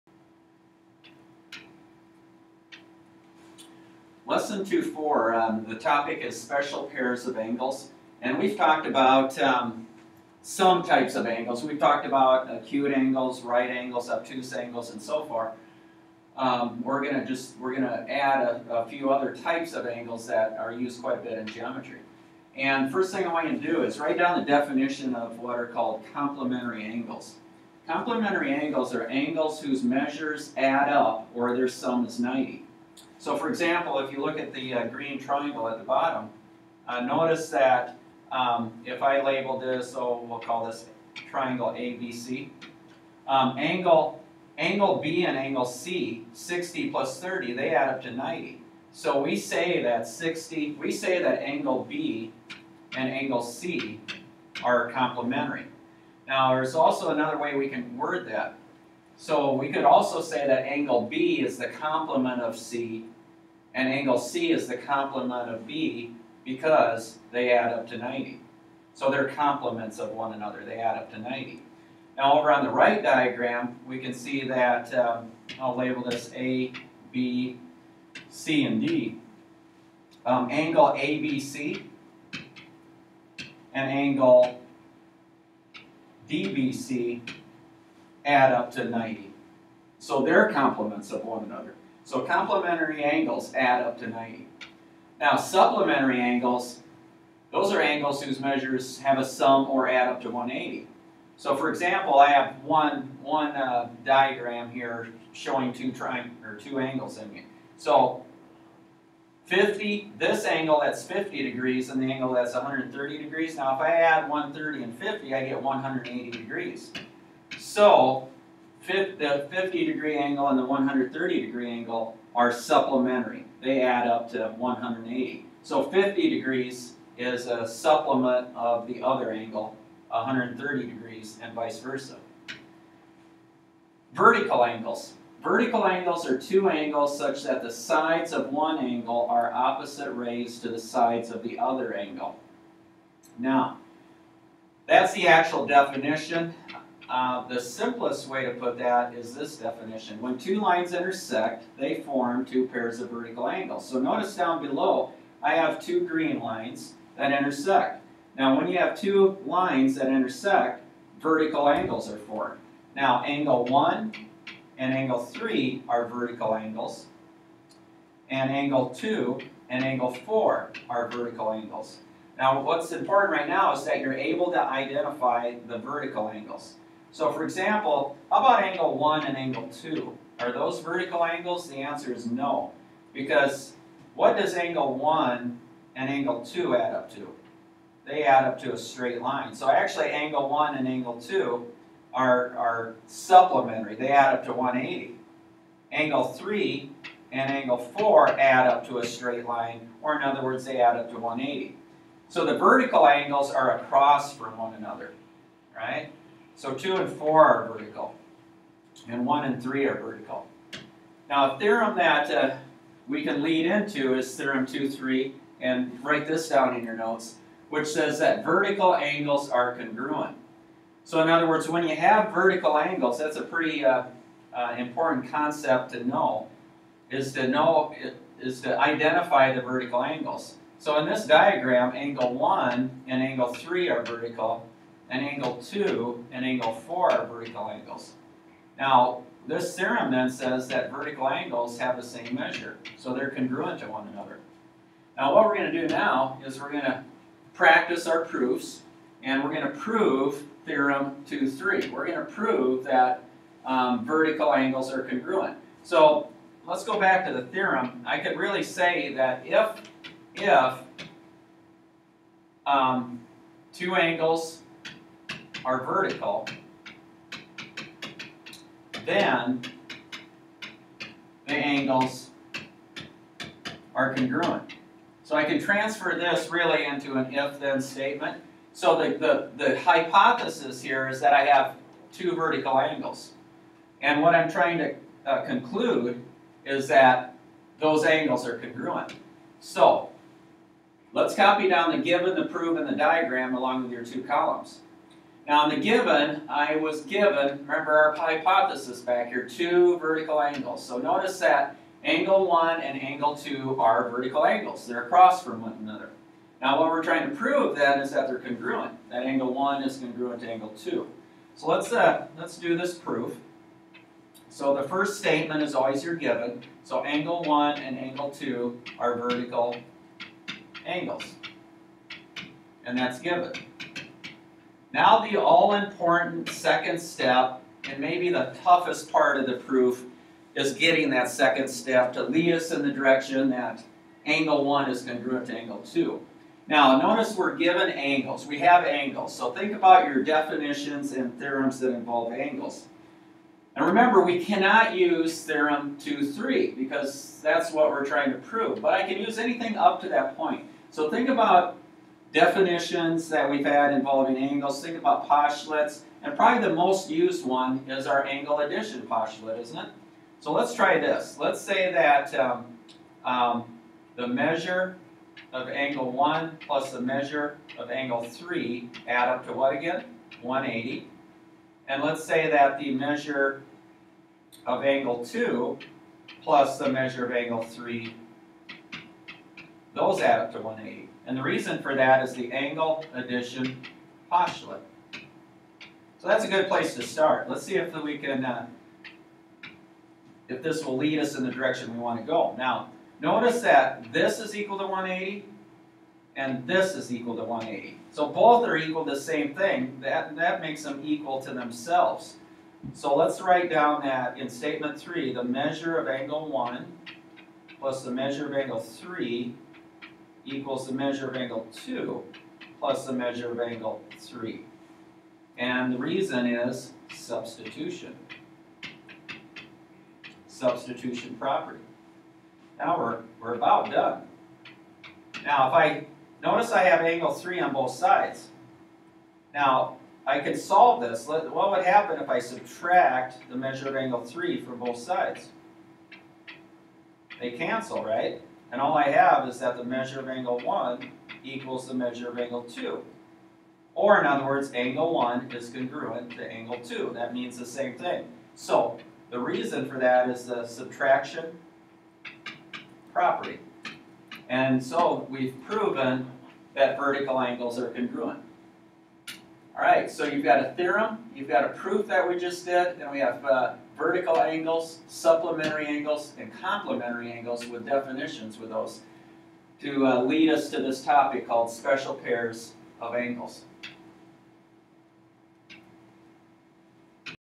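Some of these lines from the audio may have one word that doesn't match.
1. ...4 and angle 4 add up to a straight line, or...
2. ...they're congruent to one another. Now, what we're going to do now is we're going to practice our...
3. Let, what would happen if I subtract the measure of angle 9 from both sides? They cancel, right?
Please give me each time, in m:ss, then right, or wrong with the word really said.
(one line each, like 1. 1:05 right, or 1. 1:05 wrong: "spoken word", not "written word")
1. 3:16 wrong: "3", not "4"
2. 4:03 right
3. 7:11 wrong: "3", not "9".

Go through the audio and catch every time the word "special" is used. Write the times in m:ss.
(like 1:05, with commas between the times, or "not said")
0:06, 7:51.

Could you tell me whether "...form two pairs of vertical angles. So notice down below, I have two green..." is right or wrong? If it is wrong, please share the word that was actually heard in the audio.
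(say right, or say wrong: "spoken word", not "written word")
right.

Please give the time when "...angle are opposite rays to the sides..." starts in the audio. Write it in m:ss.
2:18.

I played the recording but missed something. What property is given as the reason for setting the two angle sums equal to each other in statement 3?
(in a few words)
Substitution property.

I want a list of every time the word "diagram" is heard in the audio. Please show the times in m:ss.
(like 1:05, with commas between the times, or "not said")
1:13, 1:44, 3:51, 4:52.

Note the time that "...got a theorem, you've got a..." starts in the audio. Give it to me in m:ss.
7:40.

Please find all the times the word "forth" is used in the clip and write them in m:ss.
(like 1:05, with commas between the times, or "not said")
0:15.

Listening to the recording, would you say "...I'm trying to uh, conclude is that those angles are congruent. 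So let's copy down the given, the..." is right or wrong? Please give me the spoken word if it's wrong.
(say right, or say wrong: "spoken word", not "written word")
right.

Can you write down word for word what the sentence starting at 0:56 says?
Now there's also another way we can word that.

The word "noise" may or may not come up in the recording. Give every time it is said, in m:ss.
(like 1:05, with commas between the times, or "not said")
not said.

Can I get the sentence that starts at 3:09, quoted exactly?
So actually angle 1 and angle 2 are, are supplementary.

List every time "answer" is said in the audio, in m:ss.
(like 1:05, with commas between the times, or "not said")
3:01.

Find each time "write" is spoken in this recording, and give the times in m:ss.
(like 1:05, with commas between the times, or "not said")
0:23, 3:36, 6:43.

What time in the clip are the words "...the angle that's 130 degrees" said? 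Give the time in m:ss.
1:52.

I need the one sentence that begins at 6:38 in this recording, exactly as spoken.
So both are equal to the same thing.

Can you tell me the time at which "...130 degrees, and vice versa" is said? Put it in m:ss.
2:10.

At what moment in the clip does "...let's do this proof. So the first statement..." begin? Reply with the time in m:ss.
5:12.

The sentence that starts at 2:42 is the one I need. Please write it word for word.
Now angle 1 and angle 3 are vertical angles, and angle 2 and angle 4 are vertical angles.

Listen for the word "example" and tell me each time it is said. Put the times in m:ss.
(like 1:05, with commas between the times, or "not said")
0:33, 1:41, 2:57.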